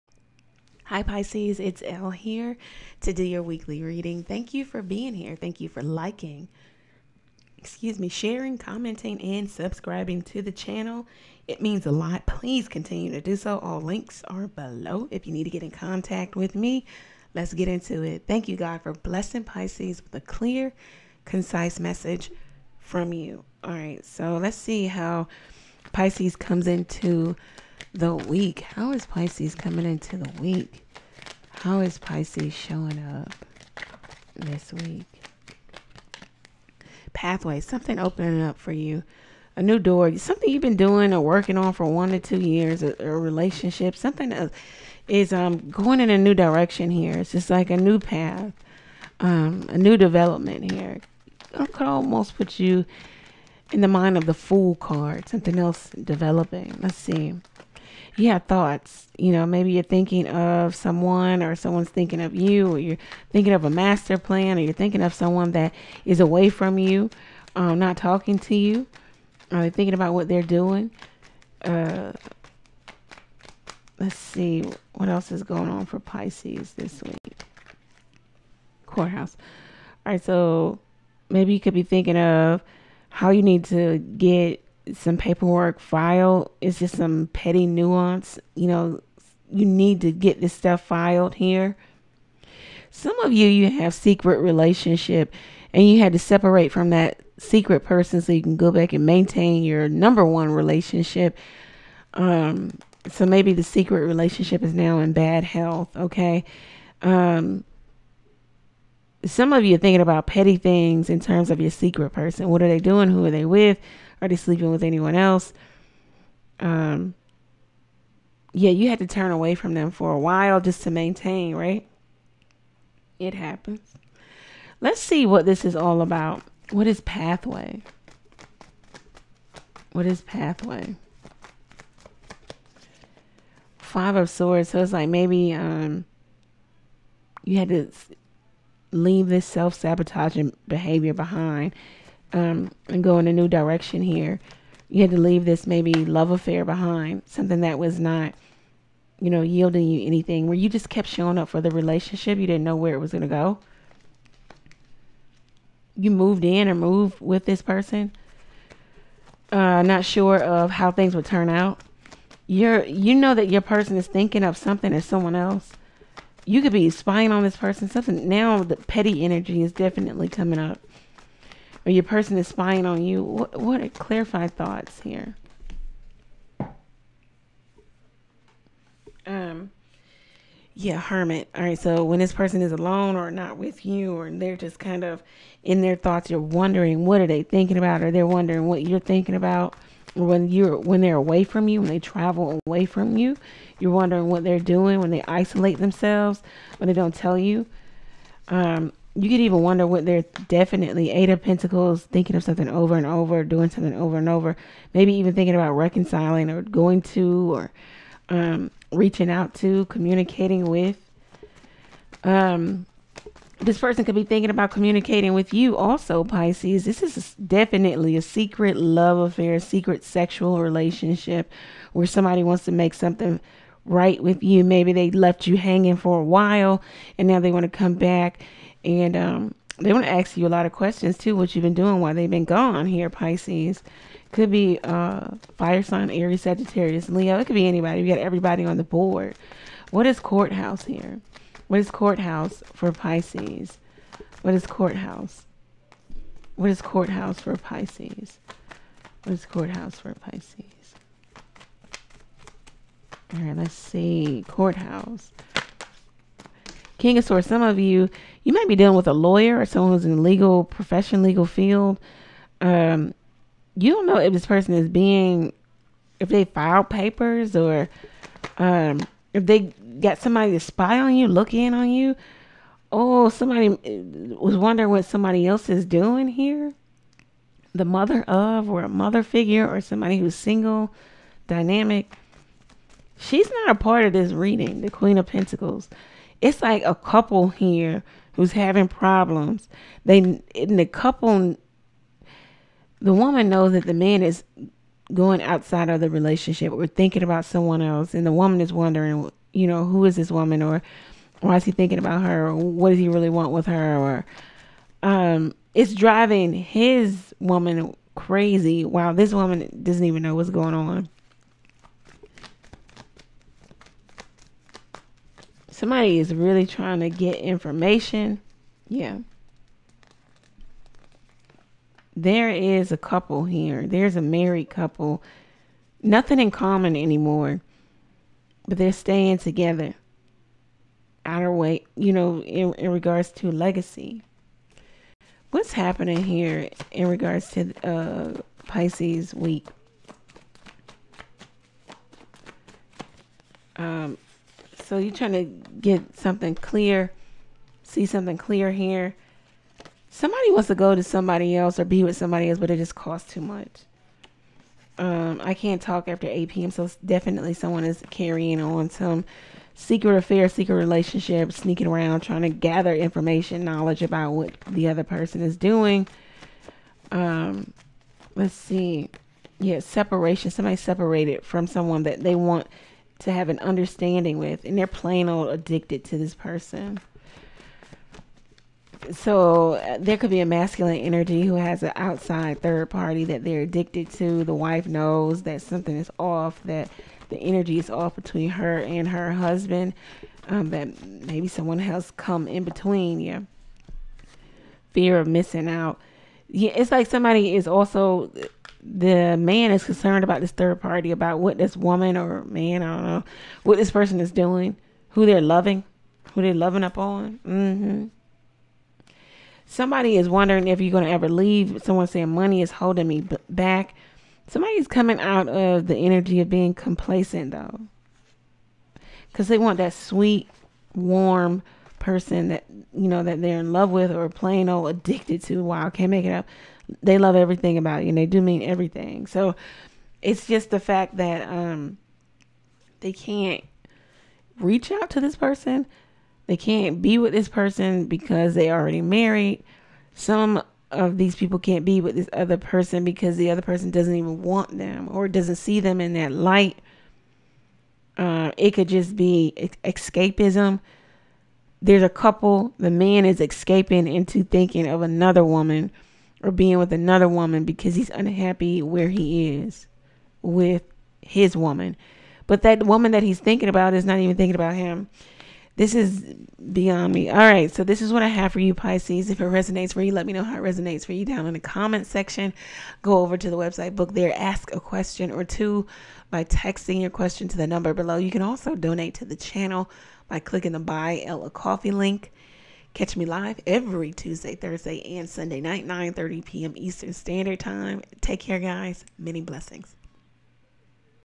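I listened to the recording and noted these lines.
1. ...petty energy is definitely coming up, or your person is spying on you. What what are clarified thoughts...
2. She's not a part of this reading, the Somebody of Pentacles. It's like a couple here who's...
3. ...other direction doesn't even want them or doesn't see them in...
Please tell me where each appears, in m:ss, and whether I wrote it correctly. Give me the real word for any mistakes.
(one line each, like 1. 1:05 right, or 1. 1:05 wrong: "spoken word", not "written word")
1. 2:48 right
2. 4:43 wrong: "Queen", not "Somebody"
3. 7:23 wrong: "person", not "direction".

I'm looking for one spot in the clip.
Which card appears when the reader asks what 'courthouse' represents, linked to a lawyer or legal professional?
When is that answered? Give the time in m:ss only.
4:16.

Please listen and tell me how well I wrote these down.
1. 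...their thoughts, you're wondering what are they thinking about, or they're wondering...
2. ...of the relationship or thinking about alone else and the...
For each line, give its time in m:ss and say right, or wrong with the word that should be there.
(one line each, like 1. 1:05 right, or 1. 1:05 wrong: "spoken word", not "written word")
1. 3:05 right
2. 4:55 wrong: "someone", not "alone".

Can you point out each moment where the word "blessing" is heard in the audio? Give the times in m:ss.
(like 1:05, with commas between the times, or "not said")
0:18, 8:09.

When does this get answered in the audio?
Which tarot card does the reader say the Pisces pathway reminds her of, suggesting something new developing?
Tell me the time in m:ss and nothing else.
0:54.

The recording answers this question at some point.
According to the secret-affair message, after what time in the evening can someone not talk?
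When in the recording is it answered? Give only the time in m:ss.
5:56.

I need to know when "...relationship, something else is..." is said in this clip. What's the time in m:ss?
0:43.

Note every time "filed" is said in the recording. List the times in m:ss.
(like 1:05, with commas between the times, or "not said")
1:25, 1:30, 4:26.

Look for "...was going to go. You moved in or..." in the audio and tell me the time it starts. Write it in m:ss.
2:32.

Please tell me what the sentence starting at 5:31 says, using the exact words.
Outer way, you know, in, in regards to legacy.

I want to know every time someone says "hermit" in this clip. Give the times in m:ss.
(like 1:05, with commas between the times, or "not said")
3:00.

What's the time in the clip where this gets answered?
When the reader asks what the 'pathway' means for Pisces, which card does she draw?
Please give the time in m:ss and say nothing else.
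2:13.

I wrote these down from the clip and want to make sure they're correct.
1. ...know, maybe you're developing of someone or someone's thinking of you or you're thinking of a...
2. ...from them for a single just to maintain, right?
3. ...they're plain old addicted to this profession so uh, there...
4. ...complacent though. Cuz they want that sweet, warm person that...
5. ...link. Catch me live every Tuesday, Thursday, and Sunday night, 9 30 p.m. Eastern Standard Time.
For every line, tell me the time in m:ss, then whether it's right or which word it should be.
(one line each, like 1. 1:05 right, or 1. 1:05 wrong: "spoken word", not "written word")
1. 0:59 wrong: "thinking", not "developing"
2. 1:59 wrong: "while", not "single"
3. 6:14 wrong: "person", not "profession"
4. 6:56 right
5. 8:01 right.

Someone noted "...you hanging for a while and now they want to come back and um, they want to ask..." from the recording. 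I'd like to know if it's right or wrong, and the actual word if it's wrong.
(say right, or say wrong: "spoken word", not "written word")
right.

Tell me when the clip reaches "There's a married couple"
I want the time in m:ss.
5:23.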